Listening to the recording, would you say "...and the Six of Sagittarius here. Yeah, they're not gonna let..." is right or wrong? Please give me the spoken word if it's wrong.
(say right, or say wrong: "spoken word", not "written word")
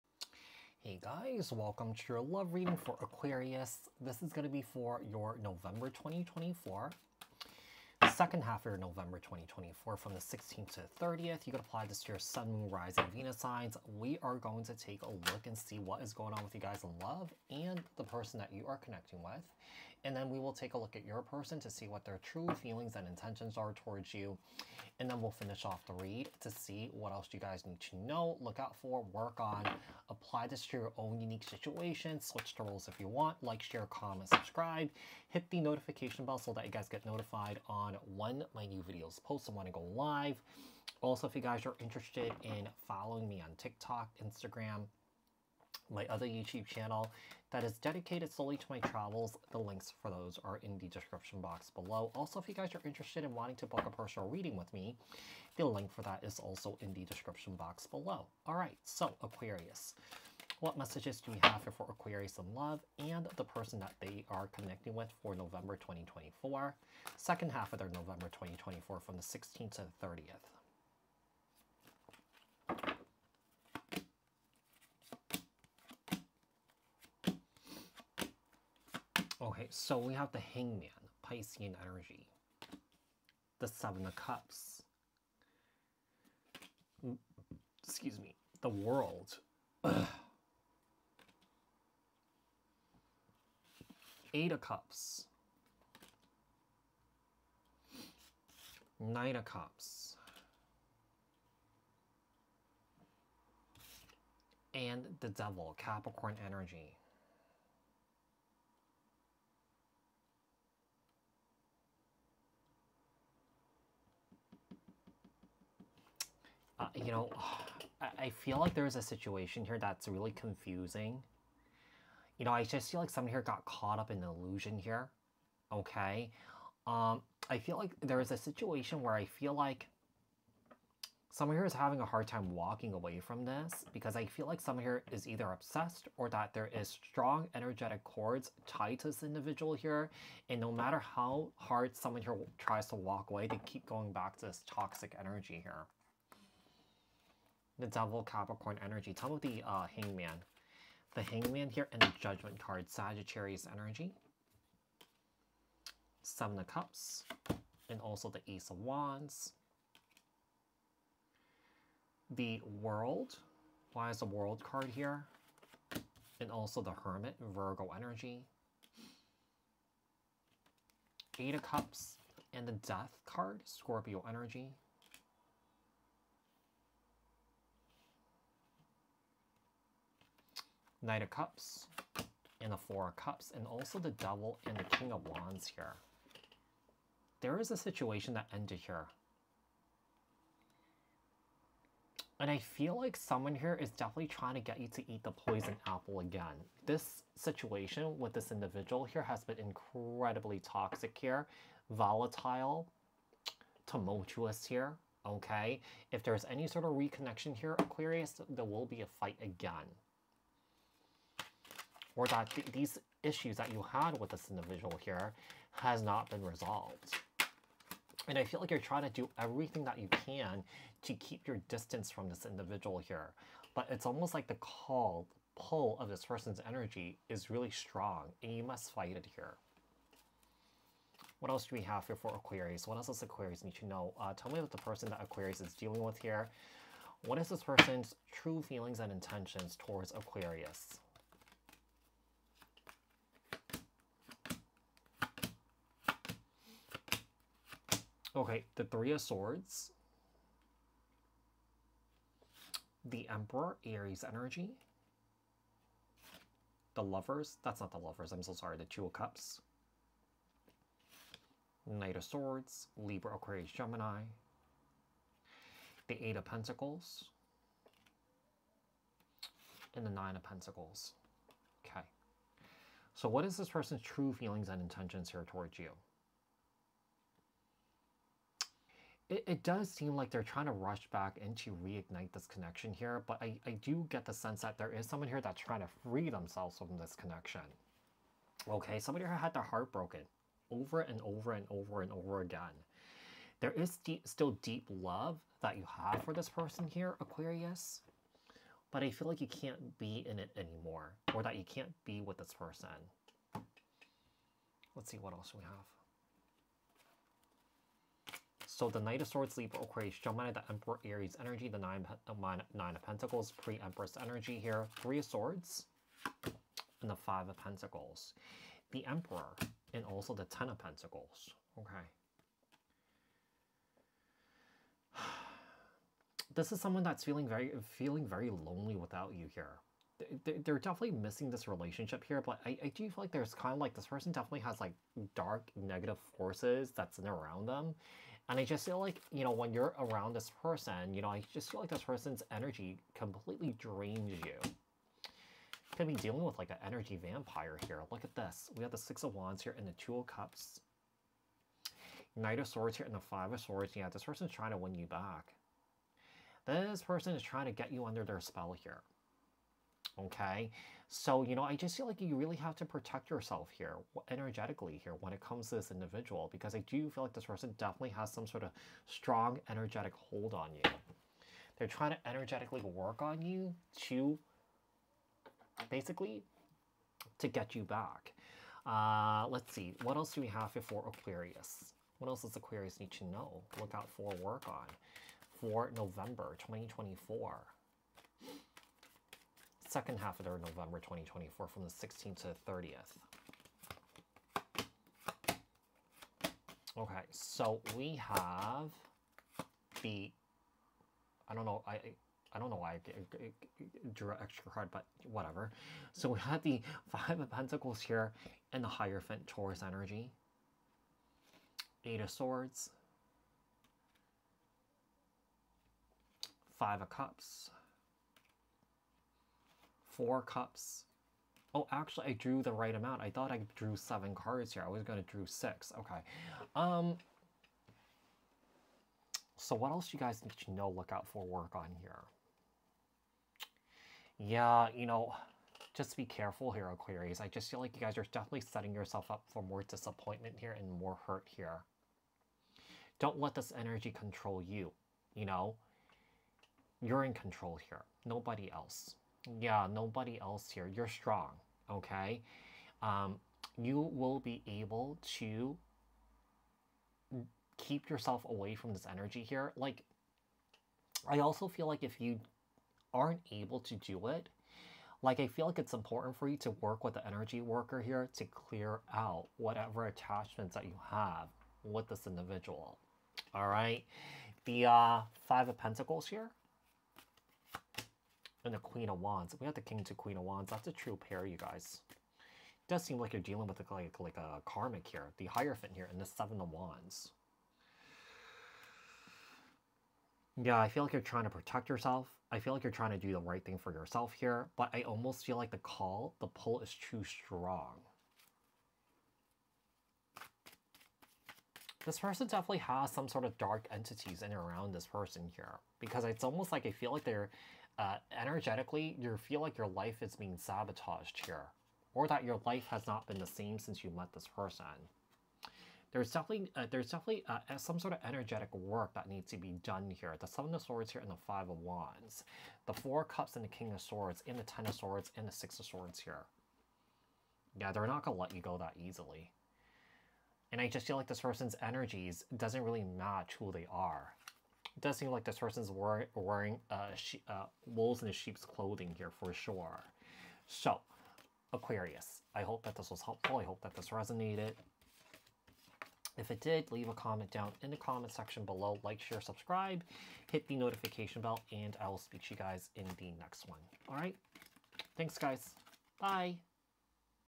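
wrong: "Swords", not "Sagittarius".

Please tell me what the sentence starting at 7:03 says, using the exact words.
I thought I drew seven cards here.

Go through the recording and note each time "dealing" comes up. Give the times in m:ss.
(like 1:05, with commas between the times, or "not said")
3:55, 5:46, 8:03.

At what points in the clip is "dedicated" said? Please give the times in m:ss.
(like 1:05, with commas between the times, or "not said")
0:47.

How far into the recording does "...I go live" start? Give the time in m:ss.
0:39.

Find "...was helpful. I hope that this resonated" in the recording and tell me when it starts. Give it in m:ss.
9:03.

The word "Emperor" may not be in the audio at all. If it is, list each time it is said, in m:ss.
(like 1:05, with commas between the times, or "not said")
4:13, 5:10, 5:19.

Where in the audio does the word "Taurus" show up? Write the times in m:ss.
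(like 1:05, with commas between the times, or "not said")
6:49.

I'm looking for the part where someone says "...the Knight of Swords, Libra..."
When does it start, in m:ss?
5:08.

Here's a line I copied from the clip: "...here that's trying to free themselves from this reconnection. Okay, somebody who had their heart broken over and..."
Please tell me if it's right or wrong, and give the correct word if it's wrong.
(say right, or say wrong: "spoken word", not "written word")
wrong: "connection", not "reconnection".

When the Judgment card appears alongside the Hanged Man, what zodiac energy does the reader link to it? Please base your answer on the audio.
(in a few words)
Sagittarius.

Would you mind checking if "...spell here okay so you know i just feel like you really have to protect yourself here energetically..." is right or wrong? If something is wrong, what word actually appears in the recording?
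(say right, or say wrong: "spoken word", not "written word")
right.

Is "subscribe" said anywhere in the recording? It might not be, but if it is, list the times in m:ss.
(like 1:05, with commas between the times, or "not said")
0:34, 9:09.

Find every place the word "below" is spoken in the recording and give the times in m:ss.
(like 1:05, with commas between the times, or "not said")
0:51, 0:57, 9:08.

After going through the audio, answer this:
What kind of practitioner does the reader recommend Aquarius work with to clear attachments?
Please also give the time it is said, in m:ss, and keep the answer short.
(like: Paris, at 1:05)
energy worker, at 7:47.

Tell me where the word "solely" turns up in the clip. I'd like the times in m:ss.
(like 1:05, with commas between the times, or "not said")
0:48.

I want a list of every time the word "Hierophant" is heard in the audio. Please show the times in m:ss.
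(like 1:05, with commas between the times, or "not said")
6:48, 8:05.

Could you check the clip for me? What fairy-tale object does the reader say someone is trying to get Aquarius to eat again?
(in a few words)
poison apple.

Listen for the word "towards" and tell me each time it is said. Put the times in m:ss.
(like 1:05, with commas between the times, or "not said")
0:23, 3:59, 4:35.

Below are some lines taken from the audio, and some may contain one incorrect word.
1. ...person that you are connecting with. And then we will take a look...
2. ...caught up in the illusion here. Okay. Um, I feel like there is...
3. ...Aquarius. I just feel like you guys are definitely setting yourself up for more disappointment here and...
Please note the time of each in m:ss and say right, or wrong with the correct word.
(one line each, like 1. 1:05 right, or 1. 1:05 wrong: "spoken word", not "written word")
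1. 0:18 right
2. 2:03 right
3. 7:16 right.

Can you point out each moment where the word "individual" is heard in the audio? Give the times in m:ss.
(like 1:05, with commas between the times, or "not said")
2:19, 3:18, 3:34, 3:42, 6:05, 7:52.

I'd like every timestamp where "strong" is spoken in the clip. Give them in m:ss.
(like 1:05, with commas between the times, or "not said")
2:16, 3:47, 6:09, 7:31, 8:17.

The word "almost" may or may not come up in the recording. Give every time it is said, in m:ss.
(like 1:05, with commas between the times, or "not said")
3:44, 8:15, 8:26.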